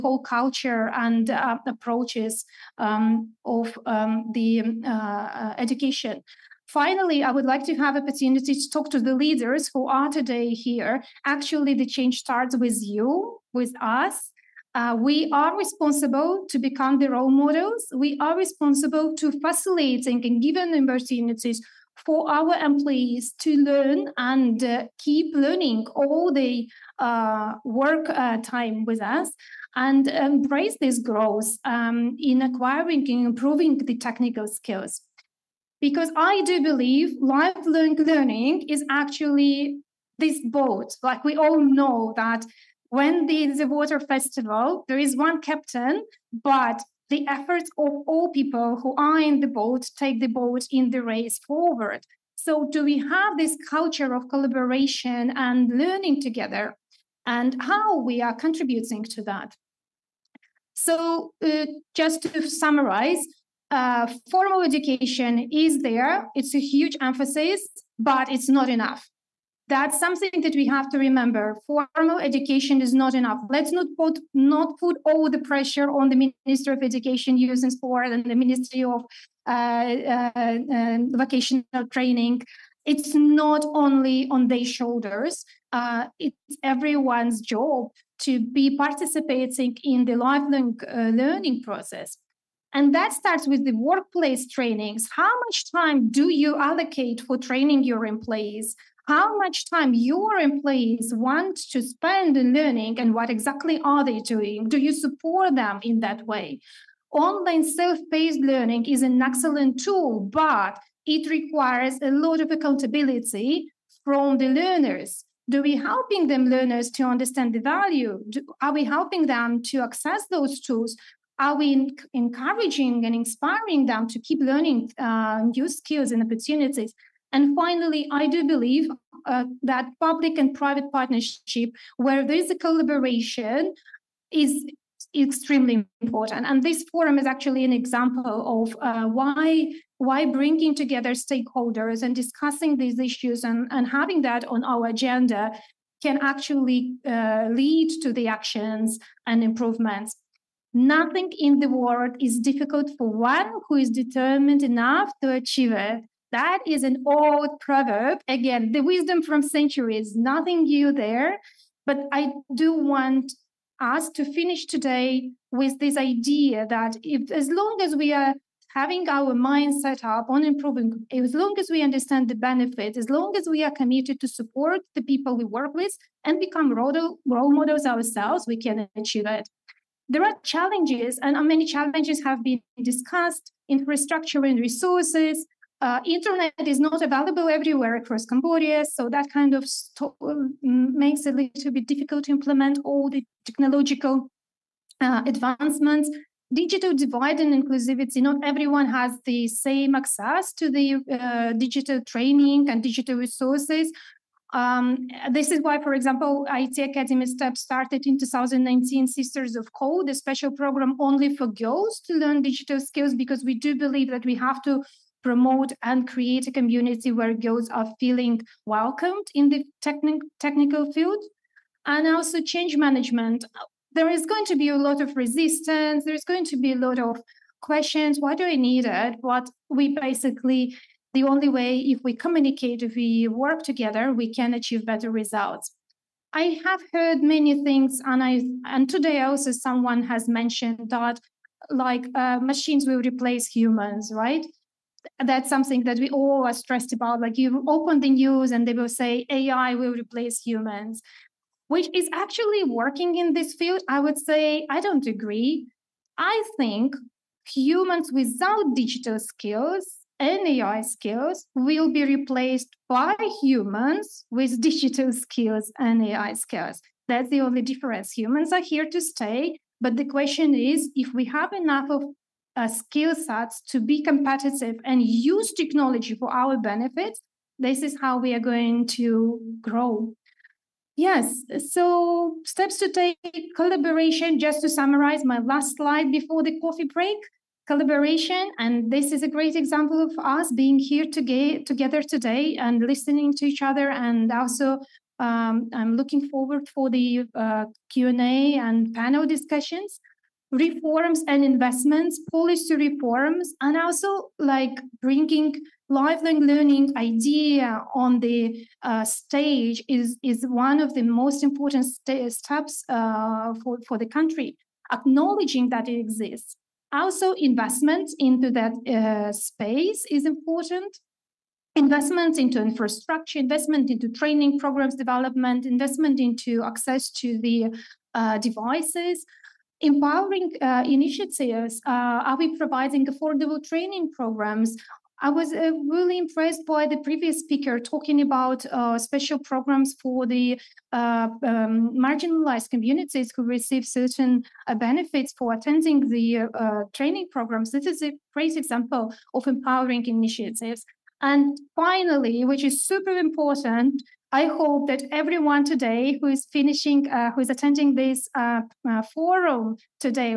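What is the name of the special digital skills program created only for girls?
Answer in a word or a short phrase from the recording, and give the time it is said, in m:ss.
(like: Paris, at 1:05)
Sisters of Code, at 3:29.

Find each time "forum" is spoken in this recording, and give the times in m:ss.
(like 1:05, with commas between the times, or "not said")
2:16, 5:59.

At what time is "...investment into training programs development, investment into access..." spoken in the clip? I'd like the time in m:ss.
5:23.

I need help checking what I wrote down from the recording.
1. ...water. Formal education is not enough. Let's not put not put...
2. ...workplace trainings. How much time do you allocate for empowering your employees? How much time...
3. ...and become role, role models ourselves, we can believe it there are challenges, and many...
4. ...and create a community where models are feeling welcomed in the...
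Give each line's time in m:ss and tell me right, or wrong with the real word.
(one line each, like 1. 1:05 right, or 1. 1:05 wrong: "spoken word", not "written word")
1. 1:10 wrong: "remember", not "water"
2. 1:33 wrong: "training", not "empowering"
3. 2:56 wrong: "achieve", not "believe"
4. 3:35 wrong: "girls", not "models".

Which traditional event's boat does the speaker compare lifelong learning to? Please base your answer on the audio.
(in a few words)
water festival.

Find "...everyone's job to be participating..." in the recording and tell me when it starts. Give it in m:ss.
1:26.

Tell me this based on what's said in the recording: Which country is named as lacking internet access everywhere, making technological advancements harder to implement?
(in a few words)
Cambodia.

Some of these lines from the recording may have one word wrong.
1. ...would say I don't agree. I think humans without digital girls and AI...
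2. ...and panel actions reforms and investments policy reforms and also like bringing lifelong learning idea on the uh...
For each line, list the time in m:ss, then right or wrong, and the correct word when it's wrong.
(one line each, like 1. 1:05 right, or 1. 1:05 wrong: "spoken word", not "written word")
1. 4:13 wrong: "skills", not "girls"
2. 4:58 wrong: "discussions", not "actions".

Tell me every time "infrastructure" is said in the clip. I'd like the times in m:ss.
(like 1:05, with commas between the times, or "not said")
3:03, 5:22.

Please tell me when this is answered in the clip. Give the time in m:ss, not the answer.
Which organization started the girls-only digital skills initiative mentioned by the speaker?
3:26.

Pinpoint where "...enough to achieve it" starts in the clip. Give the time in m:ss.
2:34.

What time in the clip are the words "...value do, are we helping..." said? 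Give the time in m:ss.
1:57.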